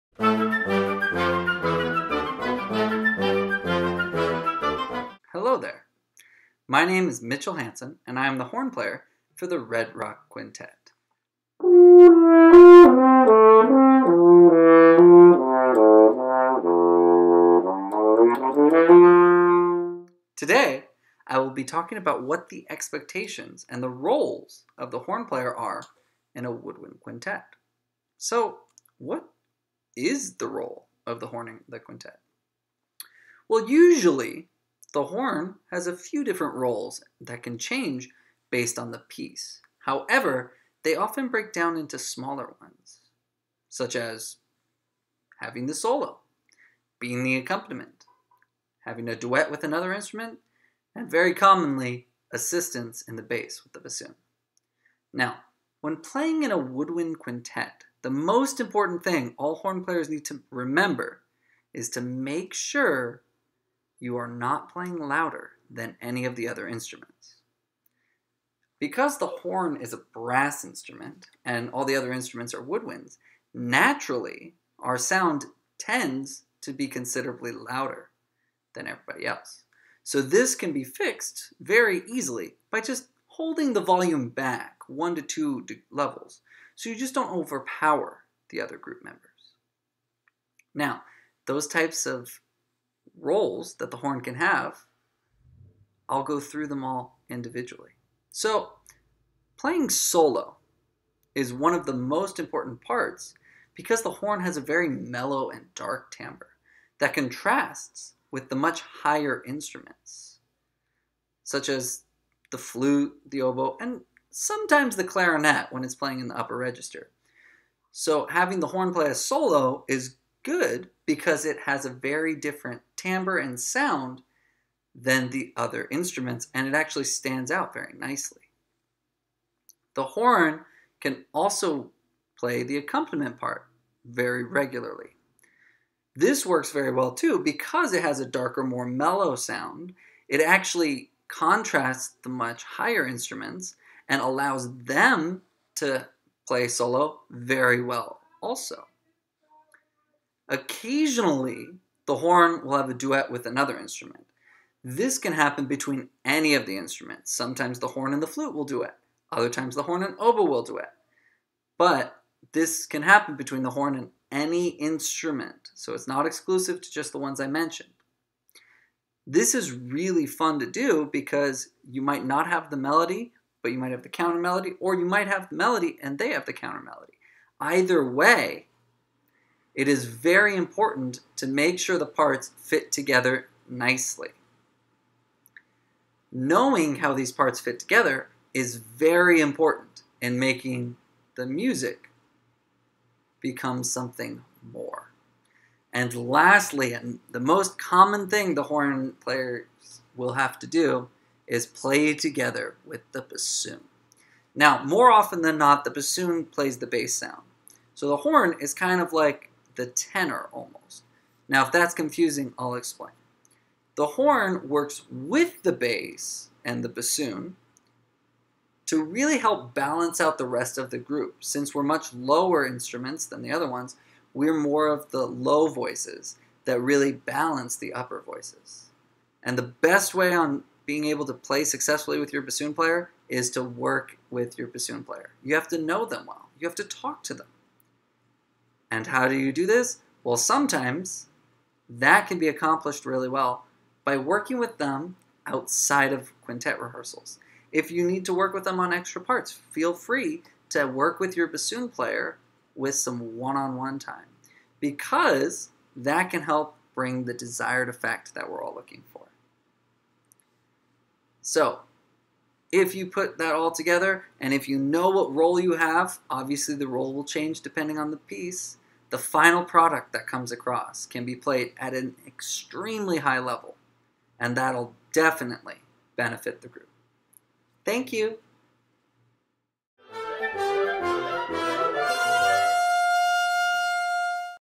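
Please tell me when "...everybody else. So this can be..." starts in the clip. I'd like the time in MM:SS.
01:18.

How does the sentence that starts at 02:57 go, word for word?
Either way, it is very important to make sure the parts fit together nicely.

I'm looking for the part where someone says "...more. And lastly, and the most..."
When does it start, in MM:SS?
03:14.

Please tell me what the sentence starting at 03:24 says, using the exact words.
Now, more often than not, the bassoon plays the bass sound.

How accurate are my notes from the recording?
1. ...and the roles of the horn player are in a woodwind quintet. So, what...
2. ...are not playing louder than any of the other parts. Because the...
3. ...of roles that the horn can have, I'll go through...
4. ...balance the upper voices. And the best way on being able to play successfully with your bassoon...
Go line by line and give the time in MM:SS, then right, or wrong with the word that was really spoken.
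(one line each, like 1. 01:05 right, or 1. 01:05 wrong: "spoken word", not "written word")
1. 00:23 right
2. 01:04 wrong: "instruments", not "parts"
3. 01:32 right
4. 03:47 right.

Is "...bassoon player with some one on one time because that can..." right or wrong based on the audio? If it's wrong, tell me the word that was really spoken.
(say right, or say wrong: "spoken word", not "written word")
right.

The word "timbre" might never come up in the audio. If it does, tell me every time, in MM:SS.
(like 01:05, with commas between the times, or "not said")
01:46, 02:03.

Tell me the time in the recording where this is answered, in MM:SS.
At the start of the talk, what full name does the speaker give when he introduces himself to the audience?
00:07.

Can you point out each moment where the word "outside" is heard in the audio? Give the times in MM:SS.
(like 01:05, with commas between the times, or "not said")
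04:05.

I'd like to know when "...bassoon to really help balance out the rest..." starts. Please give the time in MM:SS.
03:36.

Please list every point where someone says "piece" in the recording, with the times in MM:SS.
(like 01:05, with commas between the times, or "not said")
00:38, 04:28.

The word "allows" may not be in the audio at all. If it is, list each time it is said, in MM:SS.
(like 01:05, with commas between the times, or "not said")
02:24.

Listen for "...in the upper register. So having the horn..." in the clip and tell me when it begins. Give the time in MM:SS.
01:56.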